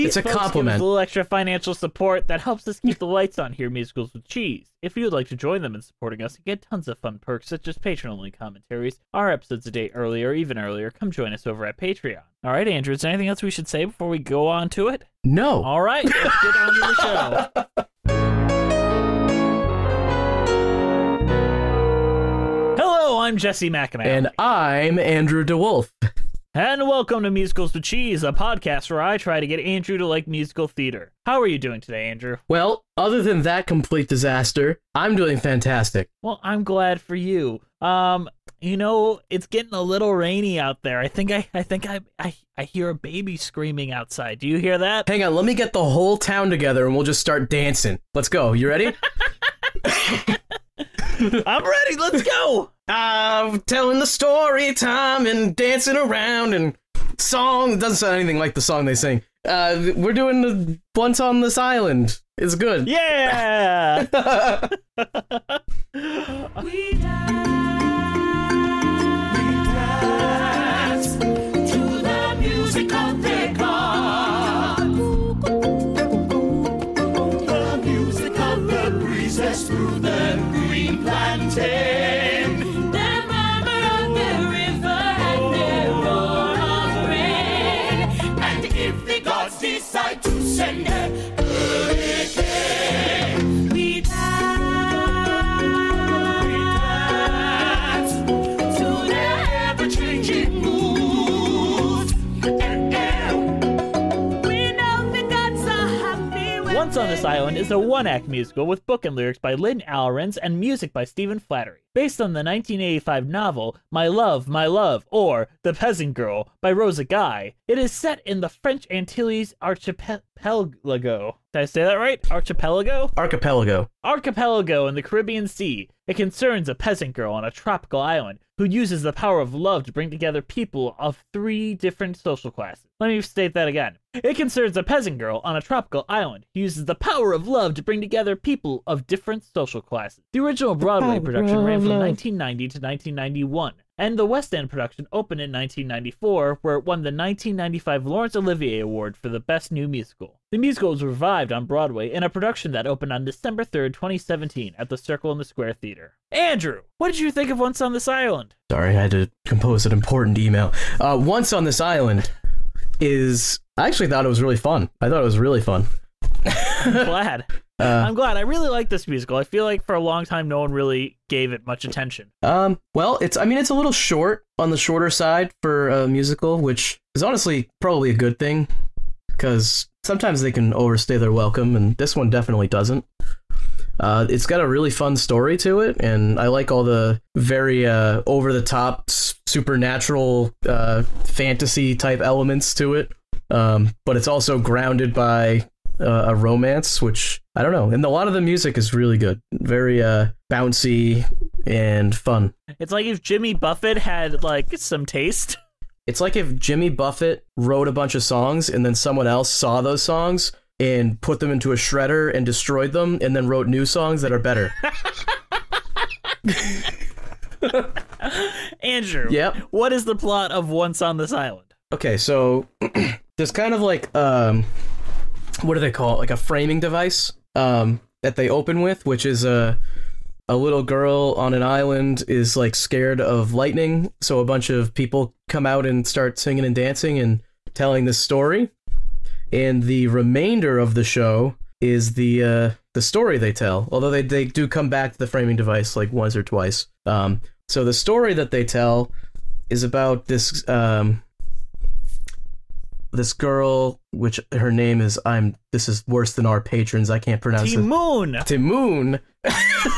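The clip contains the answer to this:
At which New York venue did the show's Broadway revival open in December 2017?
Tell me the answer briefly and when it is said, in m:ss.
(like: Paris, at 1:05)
Circle in the Square Theater, at 2:34.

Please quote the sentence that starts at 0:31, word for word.
How are you doing today, Andrew?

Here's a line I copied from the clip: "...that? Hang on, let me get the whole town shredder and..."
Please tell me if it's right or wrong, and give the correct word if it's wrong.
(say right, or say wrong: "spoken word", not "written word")
wrong: "together", not "shredder".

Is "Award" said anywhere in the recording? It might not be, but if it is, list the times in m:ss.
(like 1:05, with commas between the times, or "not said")
2:28.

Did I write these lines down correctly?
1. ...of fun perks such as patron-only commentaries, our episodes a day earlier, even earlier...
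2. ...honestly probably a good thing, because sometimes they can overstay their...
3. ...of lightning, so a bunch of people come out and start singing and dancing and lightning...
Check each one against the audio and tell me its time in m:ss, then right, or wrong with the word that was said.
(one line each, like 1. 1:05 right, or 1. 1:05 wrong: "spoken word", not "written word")
1. 0:06 right
2. 2:57 right
3. 3:53 wrong: "telling", not "lightning".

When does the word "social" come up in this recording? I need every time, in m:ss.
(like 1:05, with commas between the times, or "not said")
2:12, 2:19.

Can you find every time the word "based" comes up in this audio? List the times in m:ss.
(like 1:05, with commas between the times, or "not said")
1:51.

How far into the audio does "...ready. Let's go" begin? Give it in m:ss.
0:51.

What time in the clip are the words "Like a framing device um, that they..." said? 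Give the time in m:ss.
3:46.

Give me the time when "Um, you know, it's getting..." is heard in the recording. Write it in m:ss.
0:37.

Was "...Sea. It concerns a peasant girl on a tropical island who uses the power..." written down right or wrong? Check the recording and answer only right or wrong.
right.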